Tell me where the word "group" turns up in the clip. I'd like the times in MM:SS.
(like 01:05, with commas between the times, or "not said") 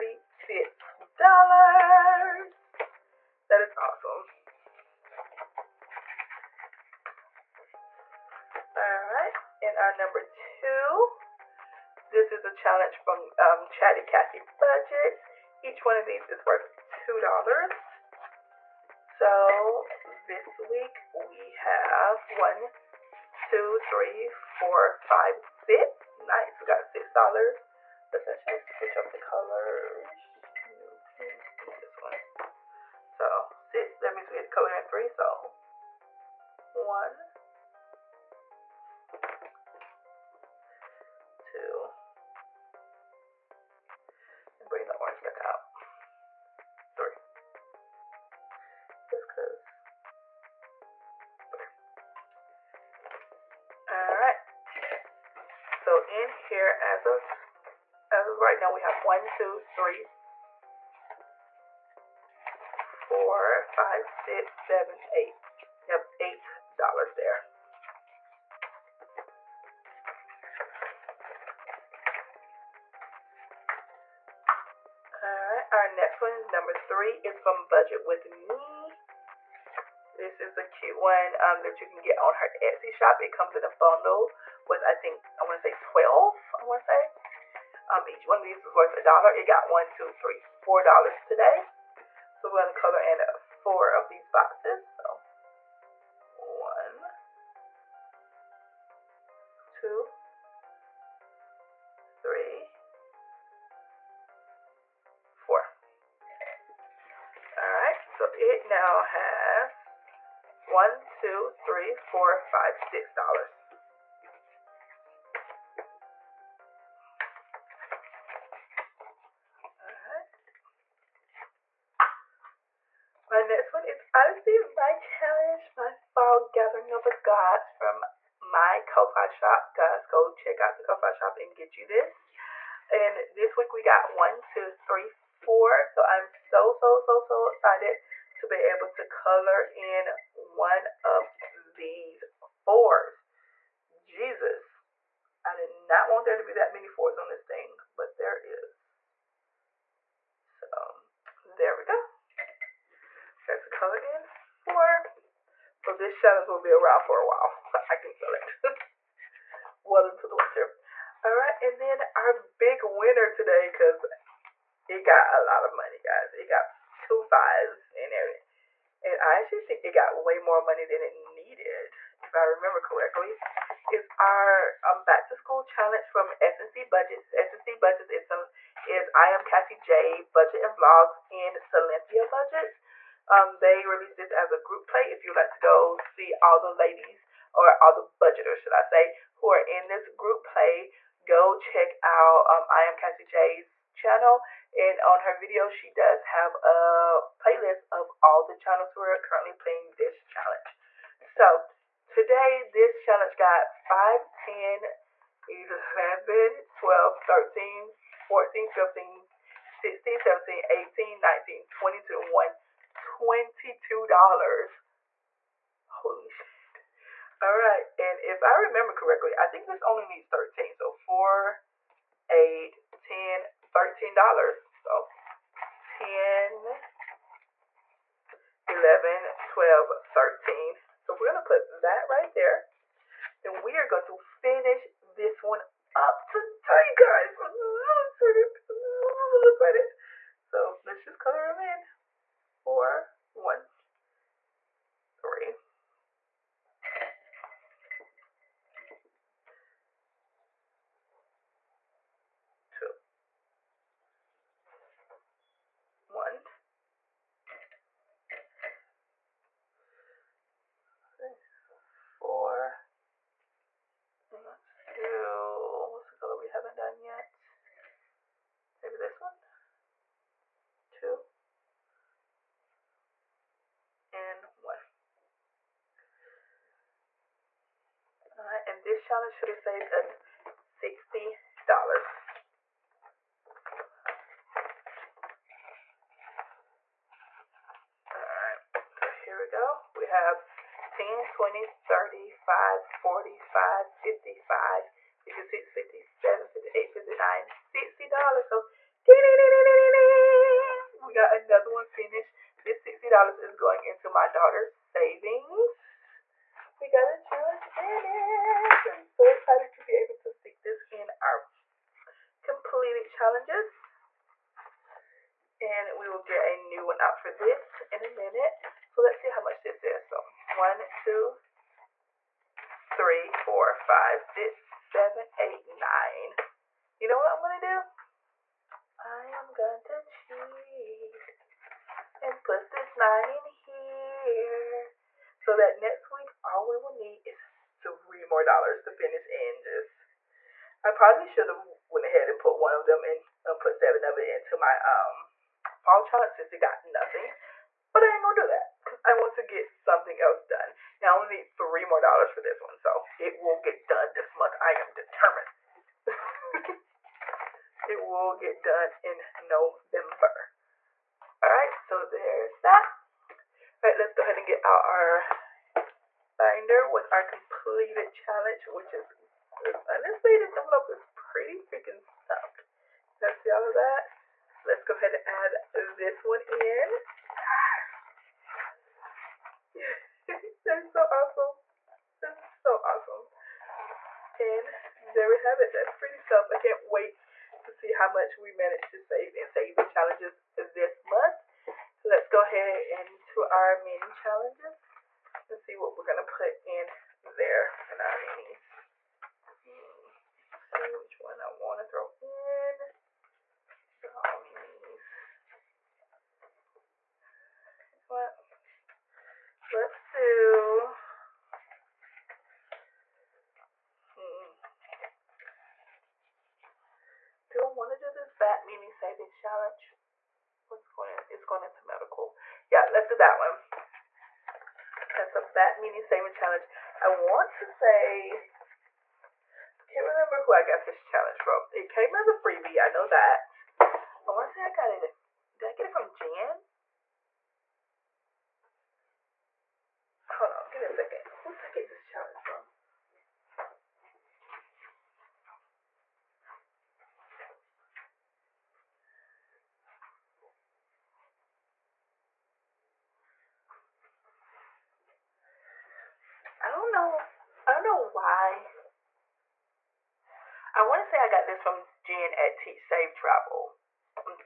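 03:04, 03:10.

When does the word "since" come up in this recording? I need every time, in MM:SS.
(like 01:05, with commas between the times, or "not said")
05:46.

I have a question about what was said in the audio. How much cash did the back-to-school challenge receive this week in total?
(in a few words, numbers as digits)
$22.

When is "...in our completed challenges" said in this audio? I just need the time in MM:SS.
05:10.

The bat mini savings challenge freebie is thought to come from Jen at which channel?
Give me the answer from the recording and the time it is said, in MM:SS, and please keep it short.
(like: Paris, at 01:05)
Teach Save Travel, at 07:42.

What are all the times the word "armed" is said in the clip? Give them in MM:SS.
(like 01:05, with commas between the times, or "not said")
not said.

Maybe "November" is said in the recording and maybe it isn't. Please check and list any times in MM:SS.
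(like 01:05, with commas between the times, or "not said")
05:59.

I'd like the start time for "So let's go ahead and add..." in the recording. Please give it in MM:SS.
06:14.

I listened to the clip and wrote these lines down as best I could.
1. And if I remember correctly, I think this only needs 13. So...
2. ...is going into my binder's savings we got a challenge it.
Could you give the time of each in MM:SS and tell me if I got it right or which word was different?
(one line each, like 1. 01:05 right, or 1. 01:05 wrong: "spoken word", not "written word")
1. 03:37 right
2. 05:03 wrong: "daughter", not "binder".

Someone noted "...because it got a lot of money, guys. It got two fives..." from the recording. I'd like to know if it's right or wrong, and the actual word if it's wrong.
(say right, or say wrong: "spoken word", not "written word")
right.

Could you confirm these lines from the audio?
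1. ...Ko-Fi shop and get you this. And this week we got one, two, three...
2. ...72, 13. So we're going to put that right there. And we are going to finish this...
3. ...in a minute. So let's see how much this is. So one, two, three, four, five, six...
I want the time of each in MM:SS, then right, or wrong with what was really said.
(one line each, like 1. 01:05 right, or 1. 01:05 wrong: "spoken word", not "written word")
1. 02:10 right
2. 03:49 wrong: "12", not "72"
3. 05:17 right.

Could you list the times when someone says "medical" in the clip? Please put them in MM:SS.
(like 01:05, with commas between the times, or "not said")
07:01.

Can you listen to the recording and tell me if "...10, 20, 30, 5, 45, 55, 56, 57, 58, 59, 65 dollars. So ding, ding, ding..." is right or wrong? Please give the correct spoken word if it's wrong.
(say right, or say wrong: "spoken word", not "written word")
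wrong: "60", not "65".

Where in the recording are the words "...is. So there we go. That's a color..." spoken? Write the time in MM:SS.
02:28.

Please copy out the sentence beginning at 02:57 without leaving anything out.
SNC Budgets is some is I am Cassie J Budget and Vlogs and Silynthia Budgets.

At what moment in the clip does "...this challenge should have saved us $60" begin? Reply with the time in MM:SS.
04:38.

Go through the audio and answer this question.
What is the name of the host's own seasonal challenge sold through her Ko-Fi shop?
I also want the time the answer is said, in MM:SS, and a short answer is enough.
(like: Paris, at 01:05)
Fall gathering of the gods, at 02:06.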